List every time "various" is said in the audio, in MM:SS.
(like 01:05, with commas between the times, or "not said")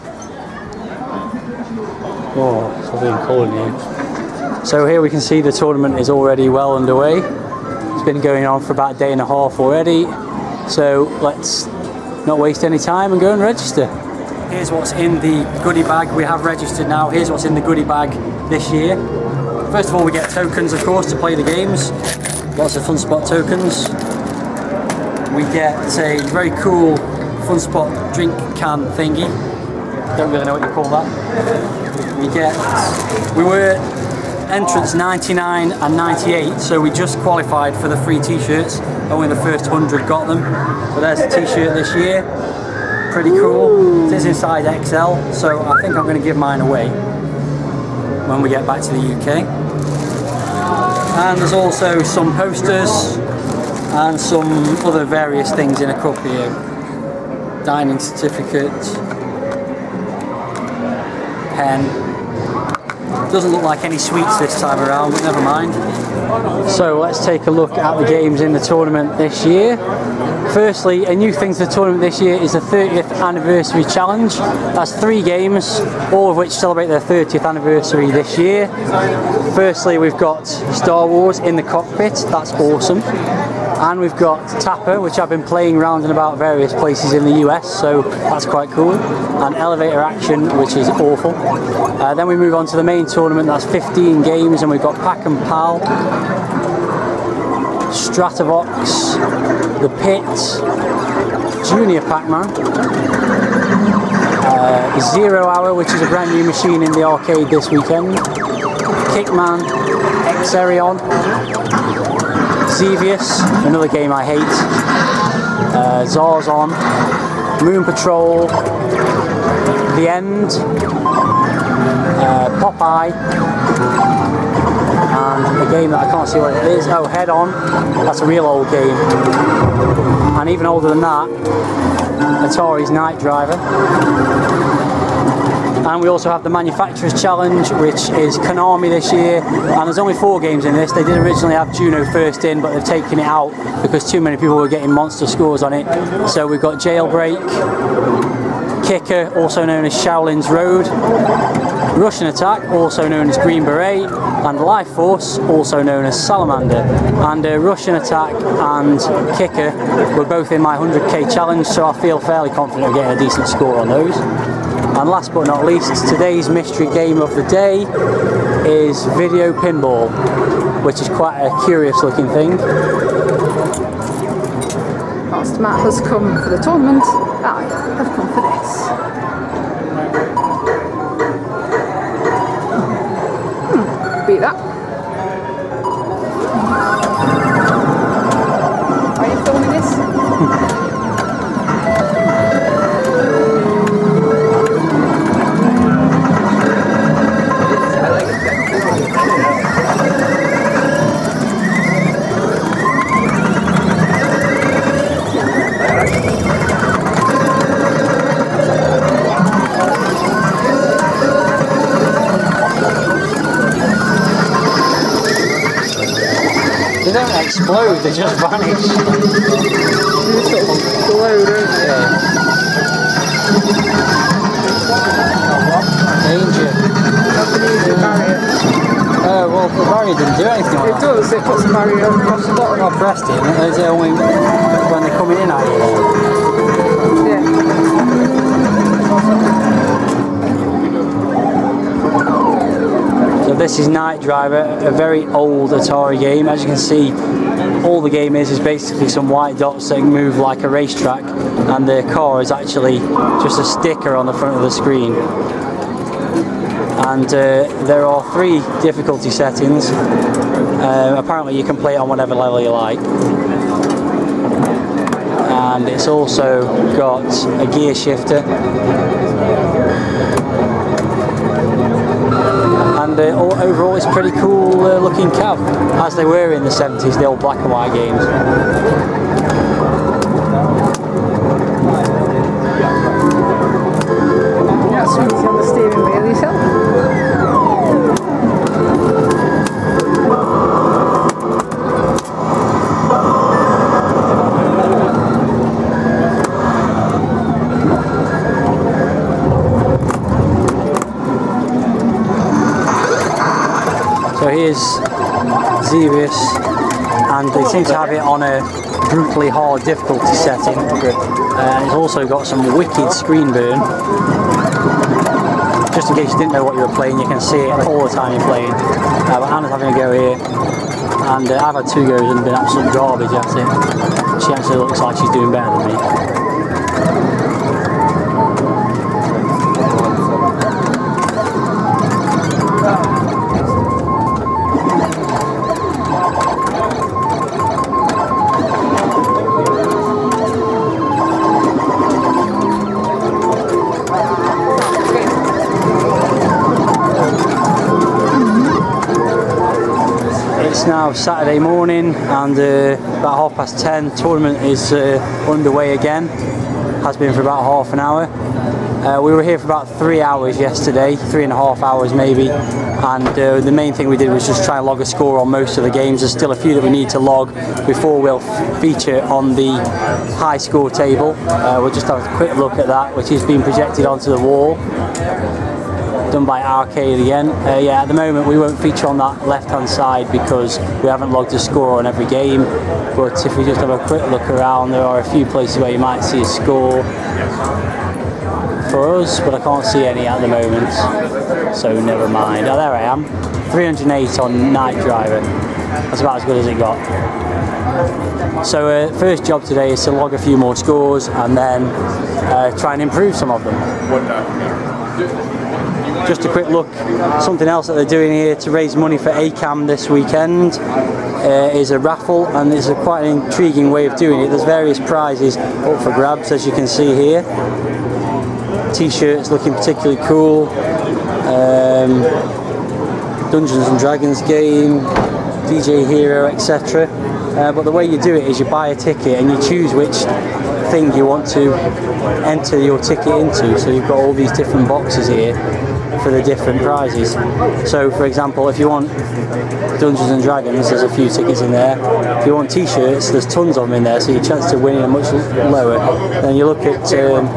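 00:55, 01:26, 06:54.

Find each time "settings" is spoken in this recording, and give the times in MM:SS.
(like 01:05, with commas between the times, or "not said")
04:19, 05:10.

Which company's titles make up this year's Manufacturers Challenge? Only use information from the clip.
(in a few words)
Konami.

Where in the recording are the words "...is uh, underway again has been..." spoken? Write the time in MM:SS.
05:54.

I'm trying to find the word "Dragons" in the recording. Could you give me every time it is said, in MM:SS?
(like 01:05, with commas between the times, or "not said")
07:03, 07:20.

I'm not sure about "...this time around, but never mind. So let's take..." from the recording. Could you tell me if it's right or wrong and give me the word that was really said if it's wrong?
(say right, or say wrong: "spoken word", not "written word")
right.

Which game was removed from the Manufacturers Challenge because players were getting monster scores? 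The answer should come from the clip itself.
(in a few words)
Juno First.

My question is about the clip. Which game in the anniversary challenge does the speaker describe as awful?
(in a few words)
Elevator Action.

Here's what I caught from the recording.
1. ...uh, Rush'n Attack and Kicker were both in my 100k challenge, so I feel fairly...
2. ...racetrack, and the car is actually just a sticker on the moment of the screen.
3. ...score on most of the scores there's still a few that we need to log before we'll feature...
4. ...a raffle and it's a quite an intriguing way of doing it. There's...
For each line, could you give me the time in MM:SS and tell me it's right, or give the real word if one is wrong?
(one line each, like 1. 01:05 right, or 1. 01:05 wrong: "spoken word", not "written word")
1. 02:37 right
2. 04:10 wrong: "front", not "moment"
3. 06:05 wrong: "games", not "scores"
4. 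06:51 right.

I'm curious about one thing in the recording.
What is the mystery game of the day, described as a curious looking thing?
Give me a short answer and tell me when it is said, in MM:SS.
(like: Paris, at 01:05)
Video Pinball, at 02:49.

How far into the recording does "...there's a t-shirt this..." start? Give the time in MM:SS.
00:40.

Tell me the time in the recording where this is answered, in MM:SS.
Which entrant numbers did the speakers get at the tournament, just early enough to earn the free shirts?
00:34.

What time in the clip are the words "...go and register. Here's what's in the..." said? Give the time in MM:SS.
00:13.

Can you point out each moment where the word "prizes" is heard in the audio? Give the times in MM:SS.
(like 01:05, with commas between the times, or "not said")
06:54, 07:16.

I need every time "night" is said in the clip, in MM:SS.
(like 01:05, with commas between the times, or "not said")
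02:12, 04:03, 06:34.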